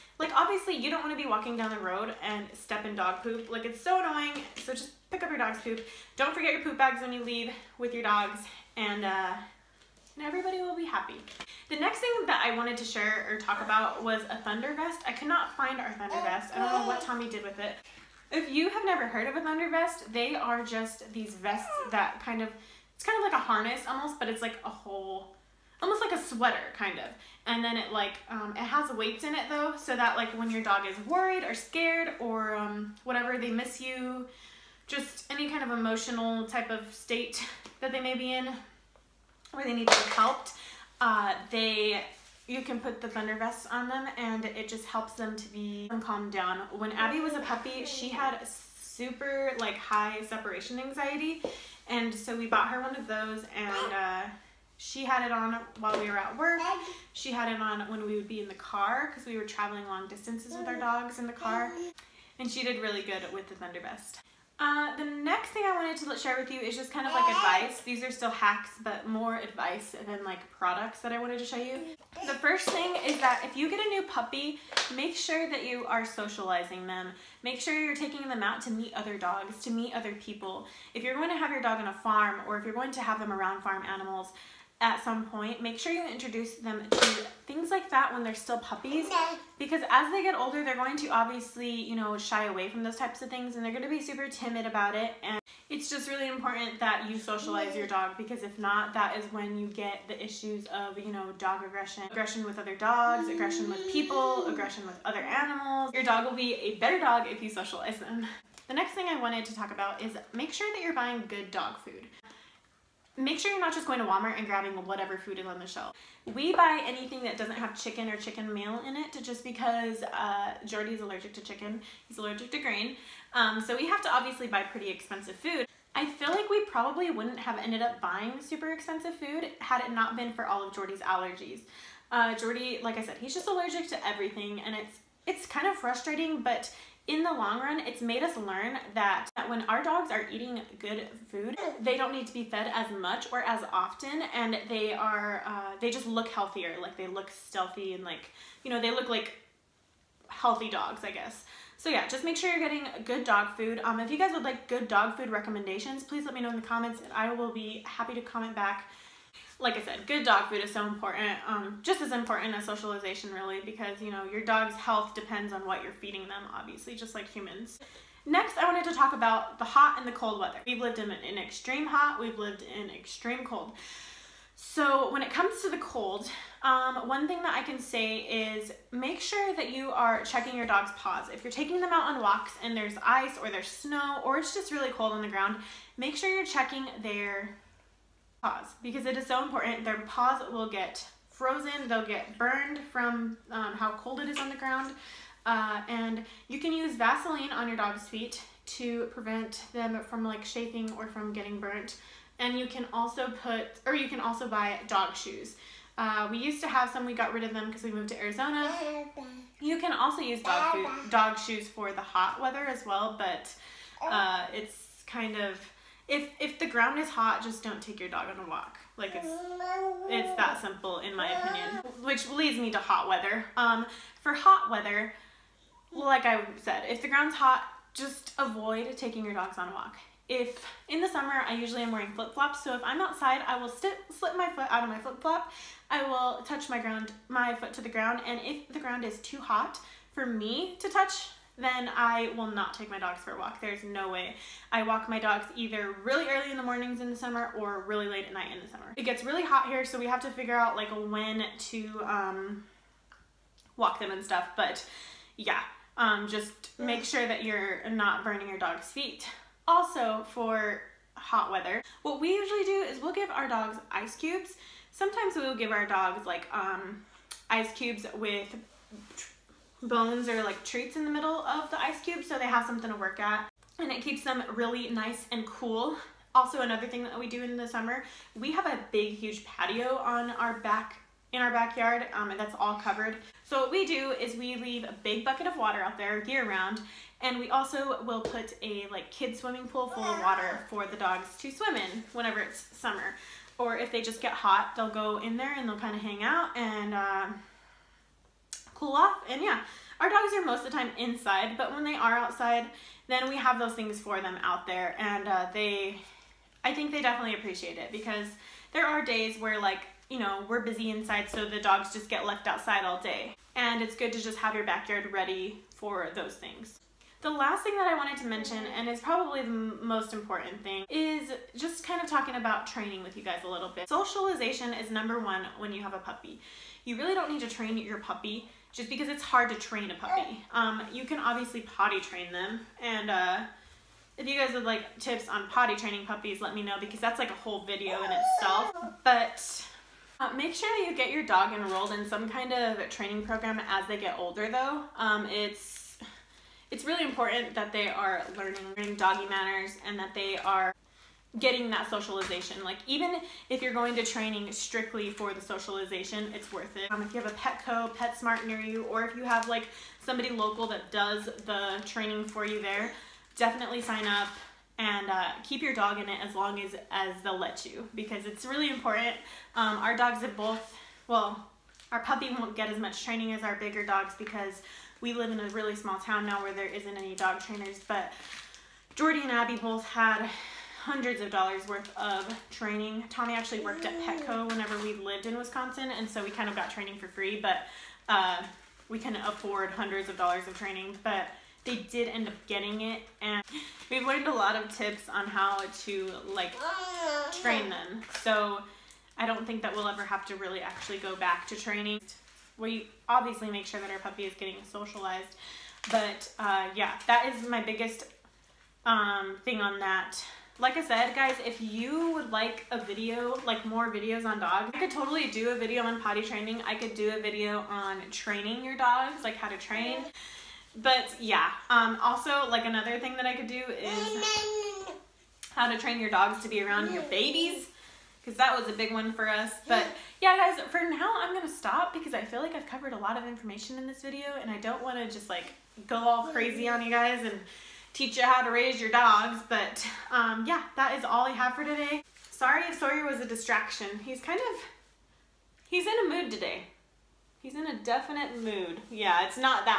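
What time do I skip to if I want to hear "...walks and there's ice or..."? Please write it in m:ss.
3:02.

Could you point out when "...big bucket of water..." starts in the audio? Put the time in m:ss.
4:45.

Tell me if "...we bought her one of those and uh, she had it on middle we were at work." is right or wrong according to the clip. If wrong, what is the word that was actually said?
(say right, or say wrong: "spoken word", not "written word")
wrong: "while", not "middle".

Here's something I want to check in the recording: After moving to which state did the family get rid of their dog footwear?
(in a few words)
Arizona.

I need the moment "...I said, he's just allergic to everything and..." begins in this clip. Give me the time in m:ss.
2:12.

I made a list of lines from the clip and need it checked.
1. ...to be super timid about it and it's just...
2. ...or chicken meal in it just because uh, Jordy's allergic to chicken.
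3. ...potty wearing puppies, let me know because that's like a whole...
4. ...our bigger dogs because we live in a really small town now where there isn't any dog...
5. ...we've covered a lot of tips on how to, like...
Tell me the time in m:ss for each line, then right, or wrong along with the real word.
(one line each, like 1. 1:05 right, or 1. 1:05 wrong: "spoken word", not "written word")
1. 1:33 right
2. 1:58 right
3. 5:35 wrong: "training", not "wearing"
4. 6:13 right
5. 6:33 wrong: "learned", not "covered".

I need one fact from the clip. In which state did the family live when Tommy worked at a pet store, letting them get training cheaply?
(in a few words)
Wisconsin.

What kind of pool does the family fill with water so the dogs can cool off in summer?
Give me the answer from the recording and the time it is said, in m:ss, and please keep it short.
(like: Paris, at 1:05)
Kid swimming pool, at 4:49.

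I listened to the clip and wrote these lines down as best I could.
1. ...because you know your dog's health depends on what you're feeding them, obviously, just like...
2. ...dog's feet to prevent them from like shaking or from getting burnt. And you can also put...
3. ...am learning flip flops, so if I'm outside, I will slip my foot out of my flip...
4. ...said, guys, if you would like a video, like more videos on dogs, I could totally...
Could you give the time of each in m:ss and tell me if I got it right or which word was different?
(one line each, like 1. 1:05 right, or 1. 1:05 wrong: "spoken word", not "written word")
1. 2:43 right
2. 3:17 right
3. 3:51 wrong: "wearing", not "learning"
4. 6:50 right.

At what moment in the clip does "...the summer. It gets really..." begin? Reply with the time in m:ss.
4:08.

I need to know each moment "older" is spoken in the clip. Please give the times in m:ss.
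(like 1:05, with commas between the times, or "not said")
1:30, 5:44.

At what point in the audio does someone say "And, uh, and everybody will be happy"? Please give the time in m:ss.
0:08.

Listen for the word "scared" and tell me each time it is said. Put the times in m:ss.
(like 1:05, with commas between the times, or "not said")
0:31.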